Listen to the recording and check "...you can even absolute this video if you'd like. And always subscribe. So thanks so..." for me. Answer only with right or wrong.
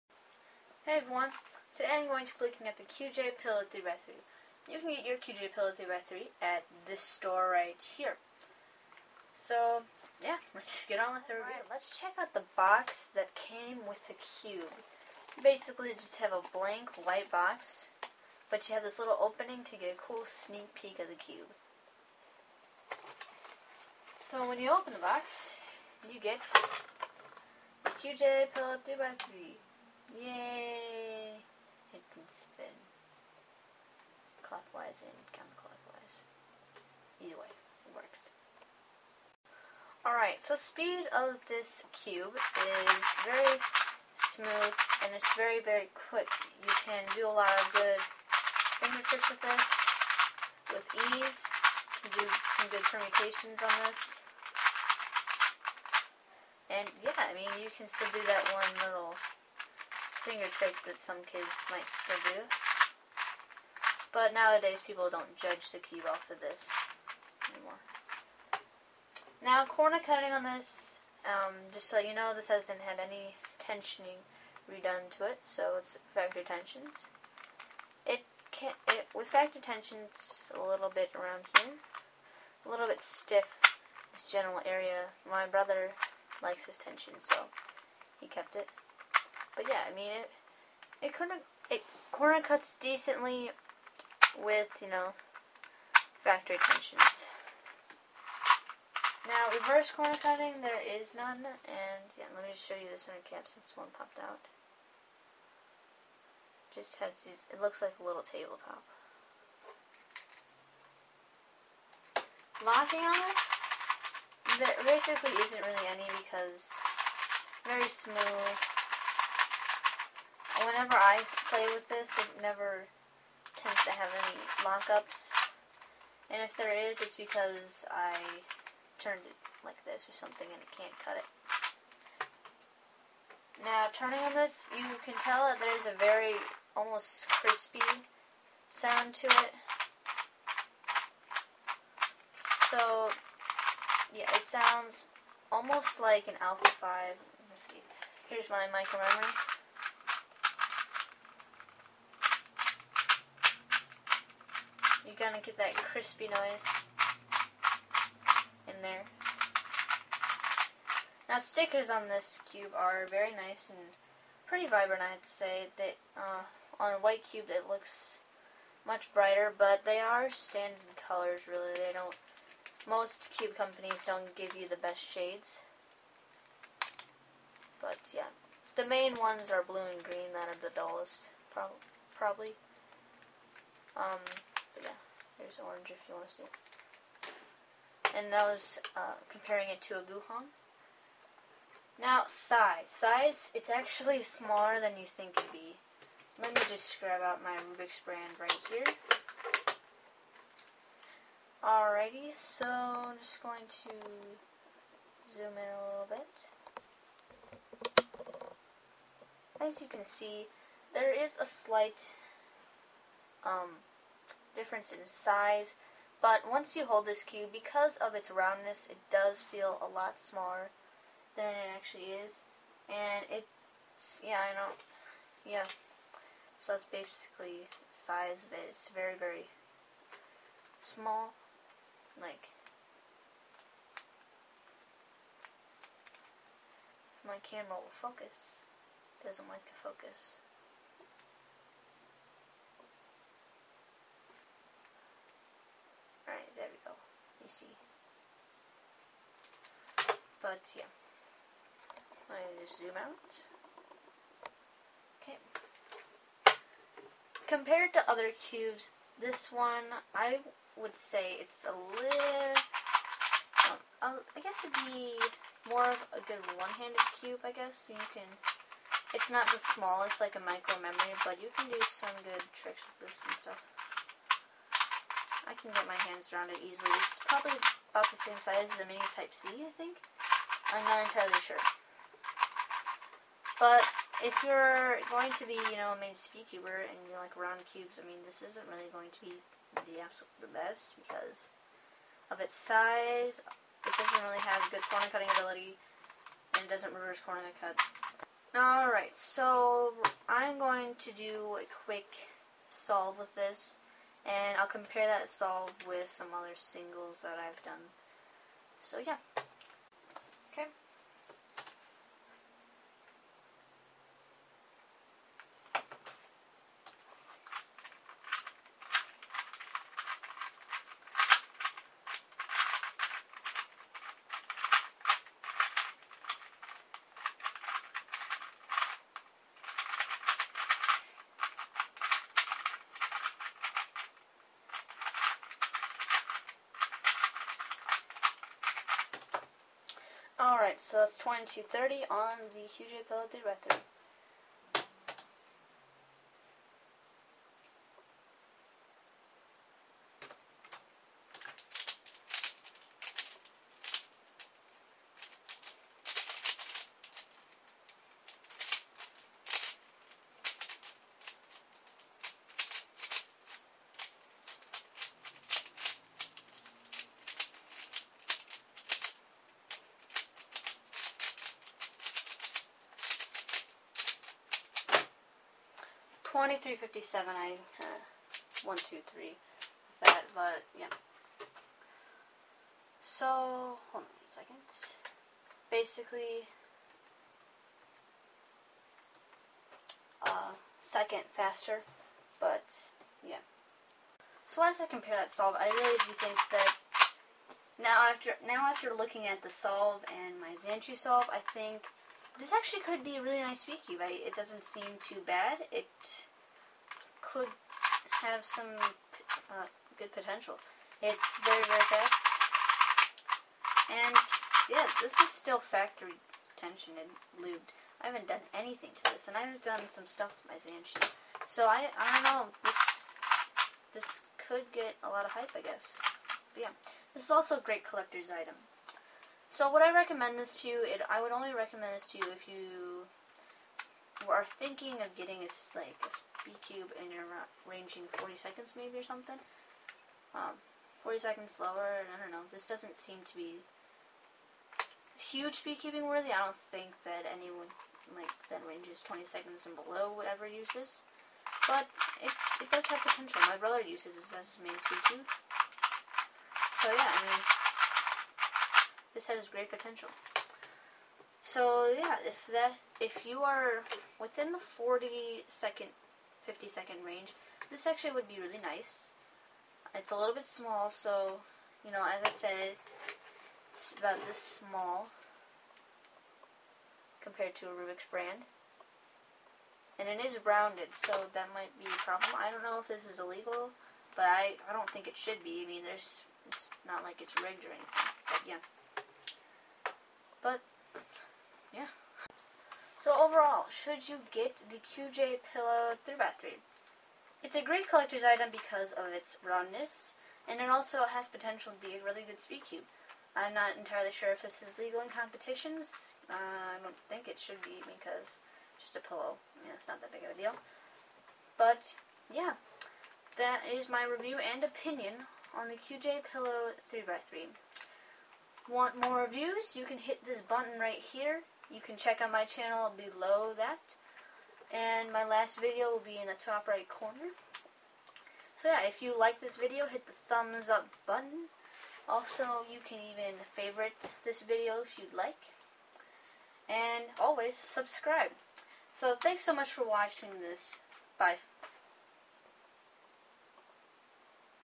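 wrong.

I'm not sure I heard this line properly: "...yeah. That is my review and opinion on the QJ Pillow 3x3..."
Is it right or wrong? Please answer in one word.
right.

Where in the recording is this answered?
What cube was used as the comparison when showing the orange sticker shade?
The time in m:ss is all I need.
3:10.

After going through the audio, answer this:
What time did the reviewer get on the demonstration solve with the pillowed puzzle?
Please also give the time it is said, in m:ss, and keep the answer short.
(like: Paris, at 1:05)
22.30, at 5:41.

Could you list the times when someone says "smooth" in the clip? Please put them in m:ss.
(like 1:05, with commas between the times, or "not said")
0:44, 1:57.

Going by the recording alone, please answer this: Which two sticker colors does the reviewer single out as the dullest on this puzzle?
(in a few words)
Blue and green.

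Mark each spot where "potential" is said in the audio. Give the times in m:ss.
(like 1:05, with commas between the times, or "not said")
6:50, 7:33, 7:39, 8:21.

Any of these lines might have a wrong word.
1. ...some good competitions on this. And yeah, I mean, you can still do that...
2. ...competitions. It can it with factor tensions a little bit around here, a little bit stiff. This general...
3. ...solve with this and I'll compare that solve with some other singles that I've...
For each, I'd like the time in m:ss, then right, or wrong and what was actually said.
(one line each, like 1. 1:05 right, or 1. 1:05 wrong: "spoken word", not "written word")
1. 0:52 wrong: "permutations", not "competitions"
2. 1:16 wrong: "tensions", not "competitions"
3. 5:02 right.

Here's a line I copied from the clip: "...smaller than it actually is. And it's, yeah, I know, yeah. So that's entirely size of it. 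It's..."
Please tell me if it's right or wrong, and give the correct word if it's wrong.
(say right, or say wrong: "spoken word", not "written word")
wrong: "basically", not "entirely".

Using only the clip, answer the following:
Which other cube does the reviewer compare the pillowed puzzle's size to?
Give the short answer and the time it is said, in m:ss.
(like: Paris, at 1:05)
Mini Type-C, at 4:38.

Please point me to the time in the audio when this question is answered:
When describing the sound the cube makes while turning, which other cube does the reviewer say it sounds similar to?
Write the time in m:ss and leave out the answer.
2:26.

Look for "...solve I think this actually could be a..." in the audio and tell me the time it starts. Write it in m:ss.
6:40.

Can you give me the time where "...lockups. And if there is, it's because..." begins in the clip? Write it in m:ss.
2:04.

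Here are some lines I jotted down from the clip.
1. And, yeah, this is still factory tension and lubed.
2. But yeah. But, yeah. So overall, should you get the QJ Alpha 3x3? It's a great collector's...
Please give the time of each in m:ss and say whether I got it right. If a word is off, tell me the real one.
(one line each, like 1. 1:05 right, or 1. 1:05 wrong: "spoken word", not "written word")
1. 6:53 right
2. 8:08 wrong: "Pillow", not "Alpha".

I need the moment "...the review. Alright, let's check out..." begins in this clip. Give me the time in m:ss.
0:11.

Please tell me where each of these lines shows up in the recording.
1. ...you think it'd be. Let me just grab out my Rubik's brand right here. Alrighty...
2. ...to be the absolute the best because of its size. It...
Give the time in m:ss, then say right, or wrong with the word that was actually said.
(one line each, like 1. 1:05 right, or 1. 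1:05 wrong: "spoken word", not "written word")
1. 3:14 right
2. 4:49 right.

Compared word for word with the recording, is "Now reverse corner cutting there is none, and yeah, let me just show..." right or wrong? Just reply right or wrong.
right.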